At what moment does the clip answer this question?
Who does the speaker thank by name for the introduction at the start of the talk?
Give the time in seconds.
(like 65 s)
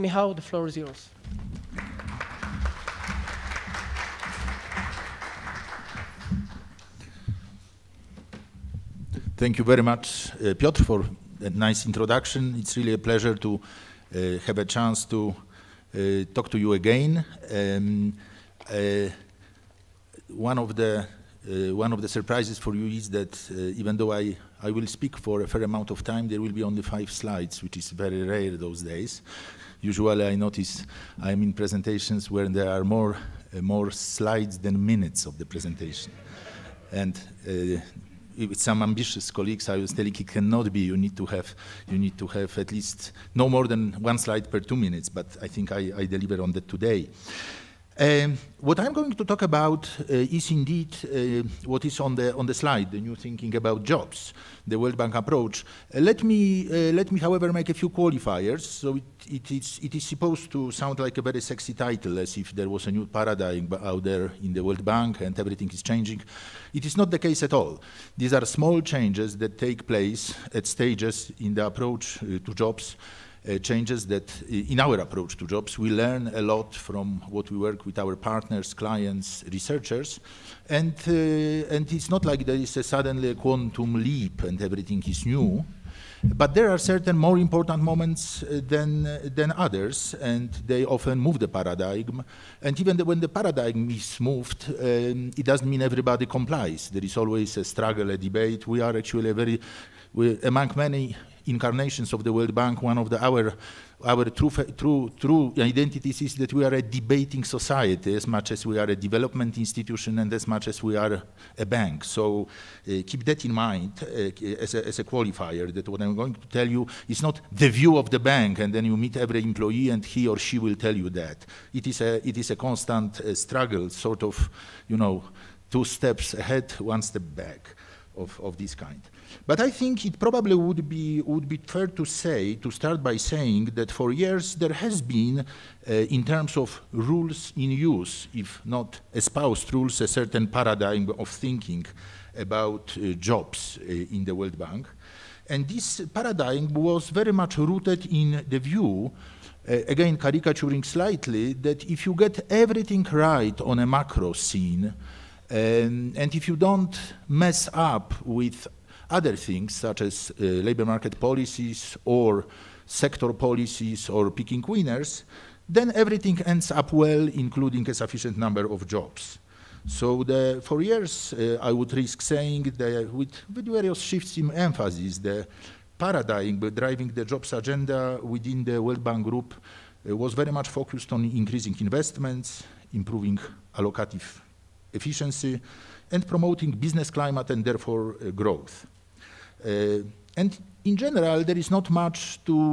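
10 s.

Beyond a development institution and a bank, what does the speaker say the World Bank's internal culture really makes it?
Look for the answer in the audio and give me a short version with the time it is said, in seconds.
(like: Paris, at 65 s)
a debating society, at 106 s.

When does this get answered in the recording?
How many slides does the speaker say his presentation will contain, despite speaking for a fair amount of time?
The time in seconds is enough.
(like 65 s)
26 s.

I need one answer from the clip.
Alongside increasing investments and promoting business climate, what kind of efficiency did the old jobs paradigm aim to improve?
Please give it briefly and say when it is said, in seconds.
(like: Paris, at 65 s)
allocative efficiency, at 183 s.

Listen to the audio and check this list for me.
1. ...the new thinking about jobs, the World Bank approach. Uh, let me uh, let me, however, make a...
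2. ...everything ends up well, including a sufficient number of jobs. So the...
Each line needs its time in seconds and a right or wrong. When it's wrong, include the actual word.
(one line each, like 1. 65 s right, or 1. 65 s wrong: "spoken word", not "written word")
1. 52 s right
2. 165 s right.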